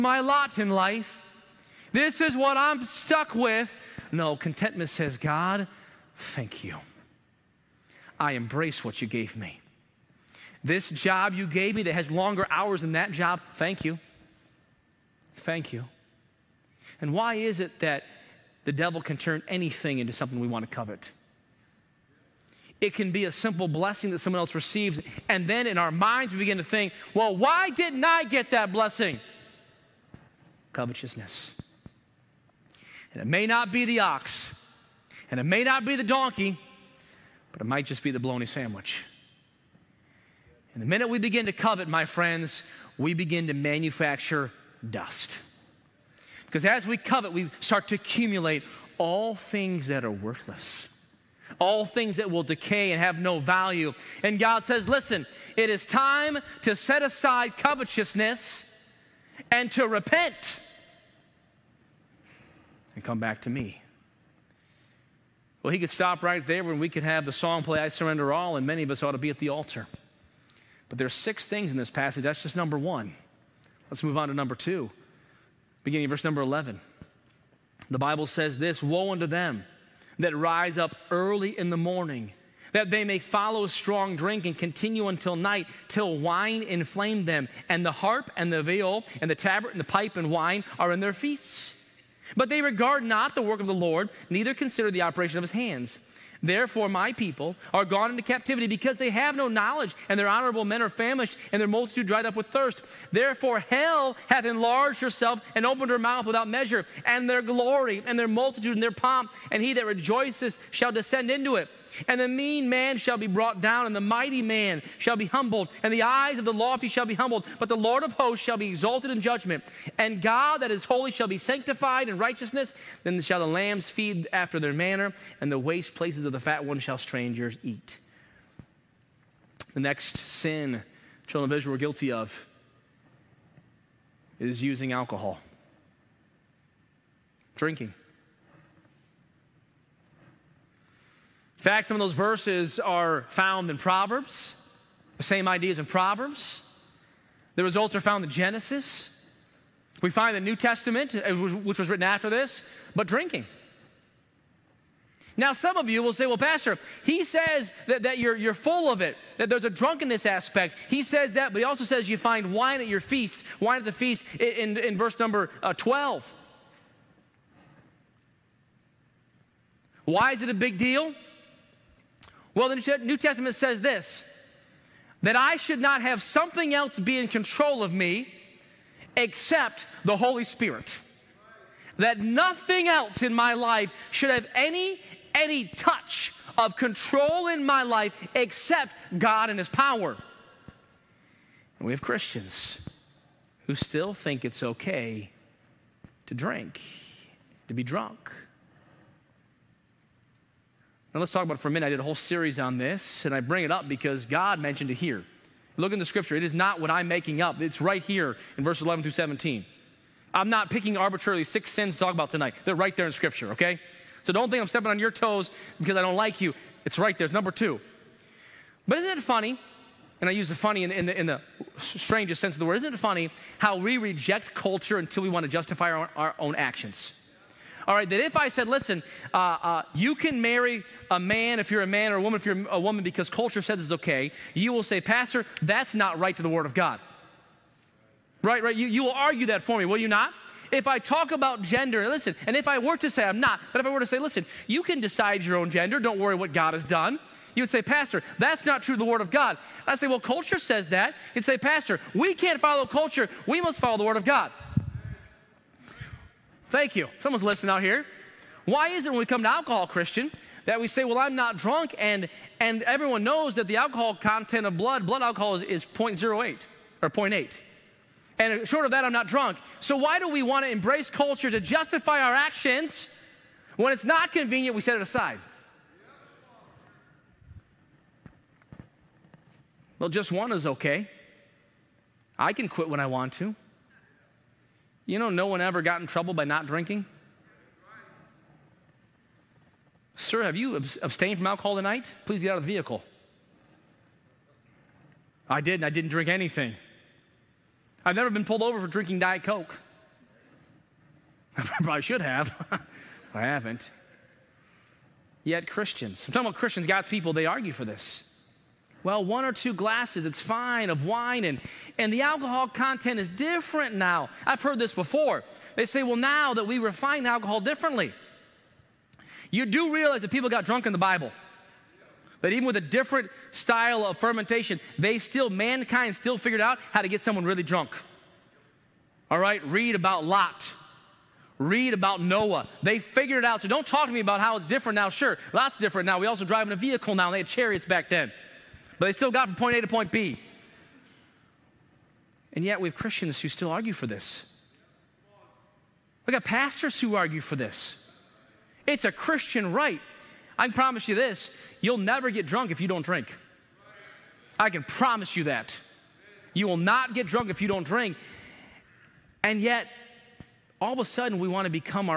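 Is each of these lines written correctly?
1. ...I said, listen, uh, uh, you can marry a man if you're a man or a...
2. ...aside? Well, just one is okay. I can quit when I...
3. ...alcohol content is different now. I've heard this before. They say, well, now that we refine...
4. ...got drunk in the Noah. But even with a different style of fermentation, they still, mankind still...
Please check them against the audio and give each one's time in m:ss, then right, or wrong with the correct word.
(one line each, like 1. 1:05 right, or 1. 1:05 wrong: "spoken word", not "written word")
1. 3:48 right
2. 4:35 right
3. 5:12 right
4. 5:20 wrong: "Bible", not "Noah".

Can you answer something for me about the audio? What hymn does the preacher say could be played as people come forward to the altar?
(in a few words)
I Surrender All.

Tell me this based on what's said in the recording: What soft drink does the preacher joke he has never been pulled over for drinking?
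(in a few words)
Diet Coke.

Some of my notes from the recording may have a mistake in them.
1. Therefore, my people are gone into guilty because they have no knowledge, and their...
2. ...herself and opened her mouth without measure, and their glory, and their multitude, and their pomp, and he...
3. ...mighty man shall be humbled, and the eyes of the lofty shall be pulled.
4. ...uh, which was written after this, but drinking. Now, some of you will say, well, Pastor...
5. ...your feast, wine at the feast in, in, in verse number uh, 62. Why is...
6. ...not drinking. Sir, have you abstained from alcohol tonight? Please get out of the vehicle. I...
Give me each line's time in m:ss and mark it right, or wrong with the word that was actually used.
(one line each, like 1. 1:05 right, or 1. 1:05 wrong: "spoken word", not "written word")
1. 1:36 wrong: "captivity", not "guilty"
2. 1:45 right
3. 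1:54 wrong: "humbled", not "pulled"
4. 2:31 right
5. 2:42 wrong: "12", not "62"
6. 4:46 right.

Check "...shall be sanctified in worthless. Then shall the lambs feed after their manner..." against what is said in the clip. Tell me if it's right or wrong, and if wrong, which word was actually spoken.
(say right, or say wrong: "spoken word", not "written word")
wrong: "righteousness", not "worthless".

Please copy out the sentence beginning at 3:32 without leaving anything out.
They're right there in scripture, okay?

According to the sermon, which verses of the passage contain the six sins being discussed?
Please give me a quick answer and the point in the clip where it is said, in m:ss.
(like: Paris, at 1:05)
11 through 17, at 3:28.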